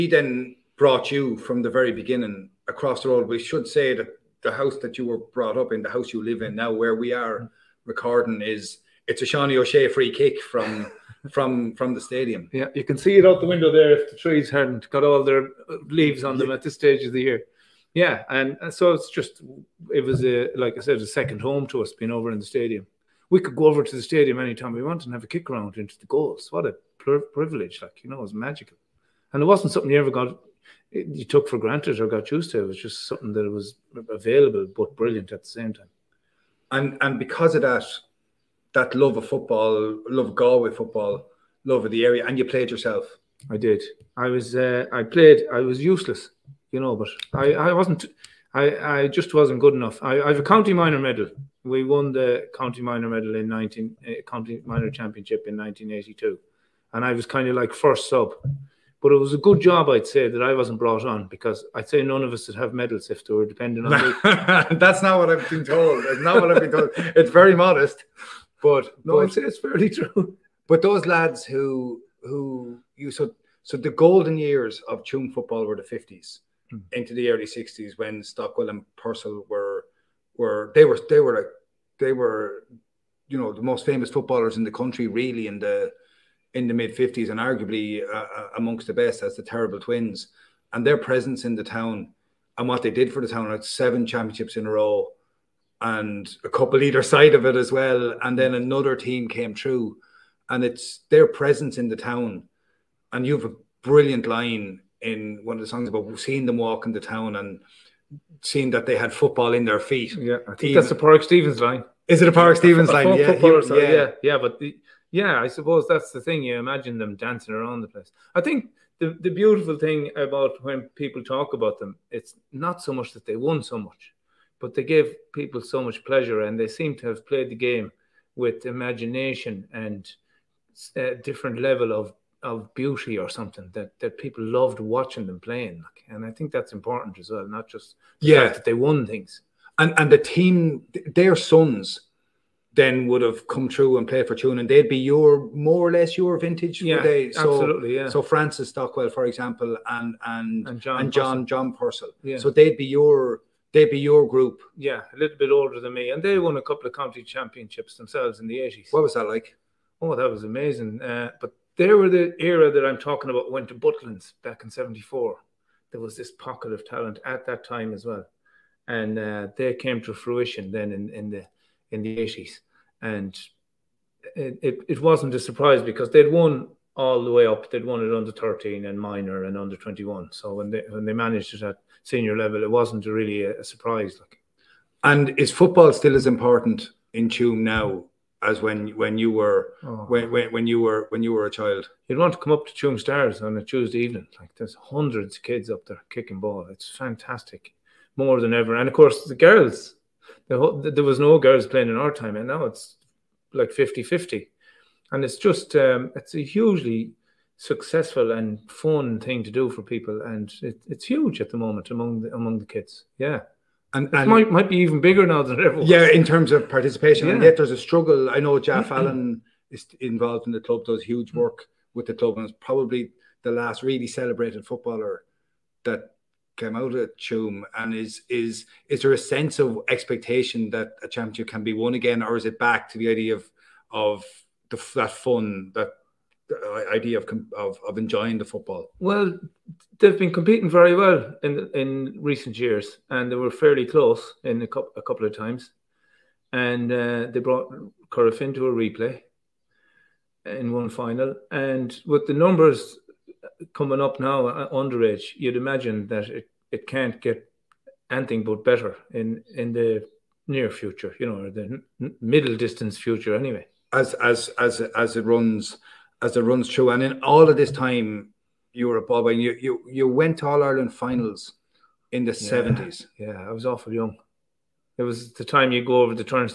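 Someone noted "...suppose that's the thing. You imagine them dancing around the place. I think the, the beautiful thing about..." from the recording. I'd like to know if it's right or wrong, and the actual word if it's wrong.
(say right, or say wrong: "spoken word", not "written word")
right.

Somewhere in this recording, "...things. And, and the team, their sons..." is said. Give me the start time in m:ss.
2:19.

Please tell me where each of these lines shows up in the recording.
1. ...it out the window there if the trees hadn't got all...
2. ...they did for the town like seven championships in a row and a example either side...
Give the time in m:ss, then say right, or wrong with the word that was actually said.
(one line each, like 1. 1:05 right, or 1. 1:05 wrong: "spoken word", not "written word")
1. 0:13 right
2. 1:32 wrong: "couple", not "example".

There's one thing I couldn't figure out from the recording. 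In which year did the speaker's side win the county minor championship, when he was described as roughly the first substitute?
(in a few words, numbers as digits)
1982.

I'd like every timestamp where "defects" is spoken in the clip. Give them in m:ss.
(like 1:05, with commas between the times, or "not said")
not said.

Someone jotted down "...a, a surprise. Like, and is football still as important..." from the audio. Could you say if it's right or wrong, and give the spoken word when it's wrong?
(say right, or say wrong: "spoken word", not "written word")
right.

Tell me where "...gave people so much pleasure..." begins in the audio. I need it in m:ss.
2:04.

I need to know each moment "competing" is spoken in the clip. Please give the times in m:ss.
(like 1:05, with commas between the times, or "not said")
4:00.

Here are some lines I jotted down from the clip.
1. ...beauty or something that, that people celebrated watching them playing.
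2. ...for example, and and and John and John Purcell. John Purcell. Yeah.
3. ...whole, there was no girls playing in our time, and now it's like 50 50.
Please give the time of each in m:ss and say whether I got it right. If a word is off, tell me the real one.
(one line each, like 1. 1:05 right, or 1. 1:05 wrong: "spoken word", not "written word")
1. 2:12 wrong: "loved", not "celebrated"
2. 2:29 right
3. 3:20 right.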